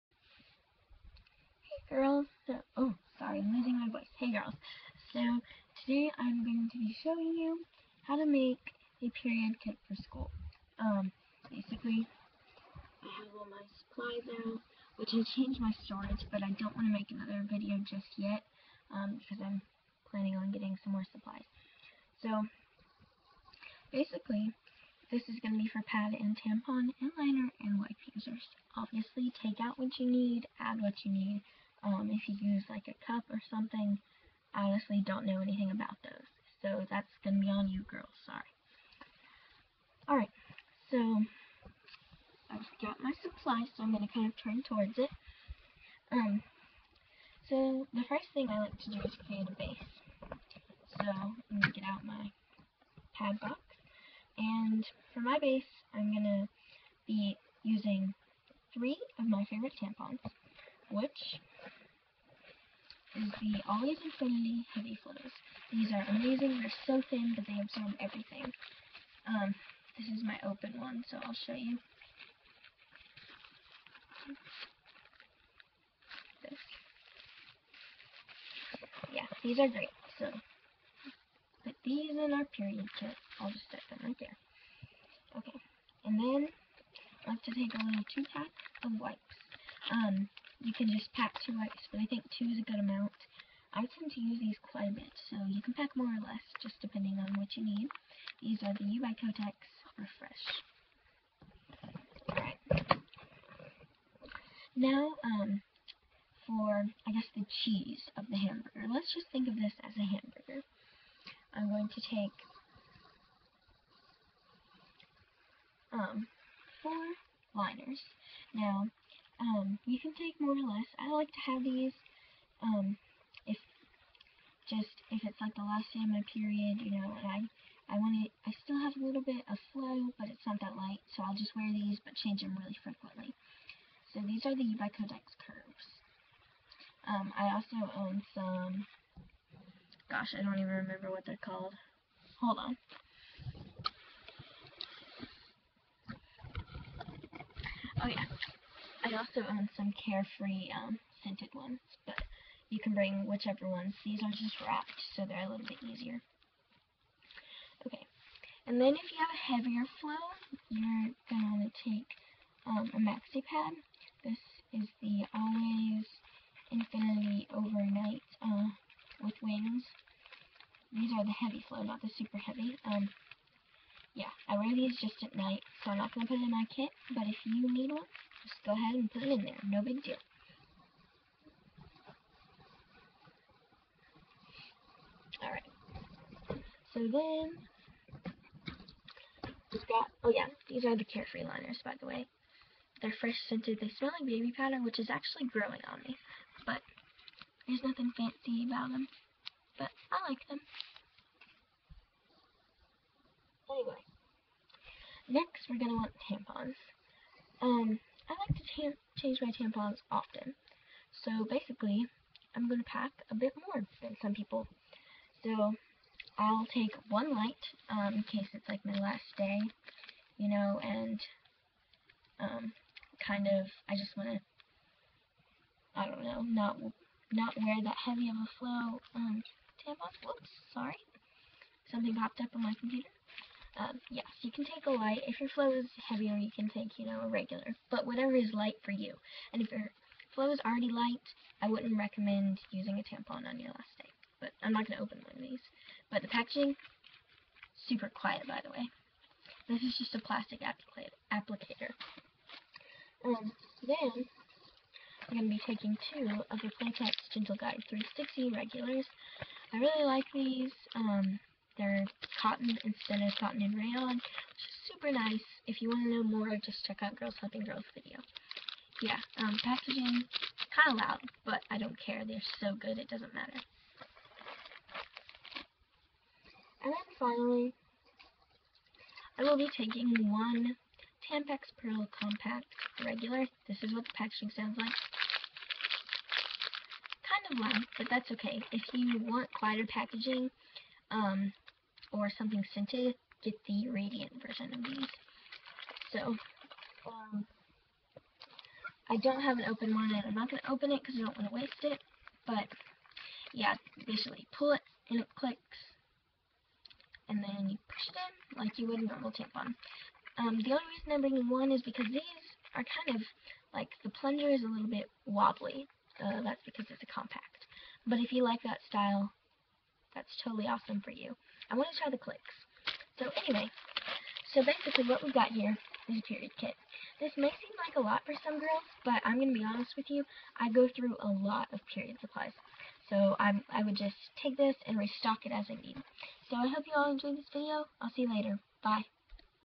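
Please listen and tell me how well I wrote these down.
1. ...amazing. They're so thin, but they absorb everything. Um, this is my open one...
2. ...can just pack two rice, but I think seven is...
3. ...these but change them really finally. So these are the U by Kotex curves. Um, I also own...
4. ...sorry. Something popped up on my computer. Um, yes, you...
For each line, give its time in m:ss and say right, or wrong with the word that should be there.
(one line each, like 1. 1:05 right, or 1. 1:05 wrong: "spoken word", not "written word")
1. 1:06 right
2. 1:30 wrong: "two", not "seven"
3. 2:11 wrong: "frequently", not "finally"
4. 3:50 right.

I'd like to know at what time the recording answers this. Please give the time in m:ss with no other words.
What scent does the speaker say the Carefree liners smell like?
3:14.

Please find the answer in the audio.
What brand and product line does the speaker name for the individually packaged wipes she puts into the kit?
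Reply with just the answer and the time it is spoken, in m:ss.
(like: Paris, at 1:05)
U by Kotex Refresh, at 1:38.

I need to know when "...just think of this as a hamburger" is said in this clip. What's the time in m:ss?
1:49.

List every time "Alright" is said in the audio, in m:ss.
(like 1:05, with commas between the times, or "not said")
0:40, 1:42, 3:05.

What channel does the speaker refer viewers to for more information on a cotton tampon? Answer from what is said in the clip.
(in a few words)
Girls Helping Girls.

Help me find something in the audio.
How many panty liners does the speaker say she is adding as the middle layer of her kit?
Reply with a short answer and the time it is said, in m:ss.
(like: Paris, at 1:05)
4, at 1:56.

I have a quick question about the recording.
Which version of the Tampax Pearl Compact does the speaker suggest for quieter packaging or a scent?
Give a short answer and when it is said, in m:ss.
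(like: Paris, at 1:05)
radiant, at 4:53.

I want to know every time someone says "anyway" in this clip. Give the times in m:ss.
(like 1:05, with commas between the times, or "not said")
3:23, 5:23.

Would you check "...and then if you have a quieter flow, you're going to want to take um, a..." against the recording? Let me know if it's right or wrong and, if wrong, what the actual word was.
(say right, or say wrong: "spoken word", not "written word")
wrong: "heavier", not "quieter".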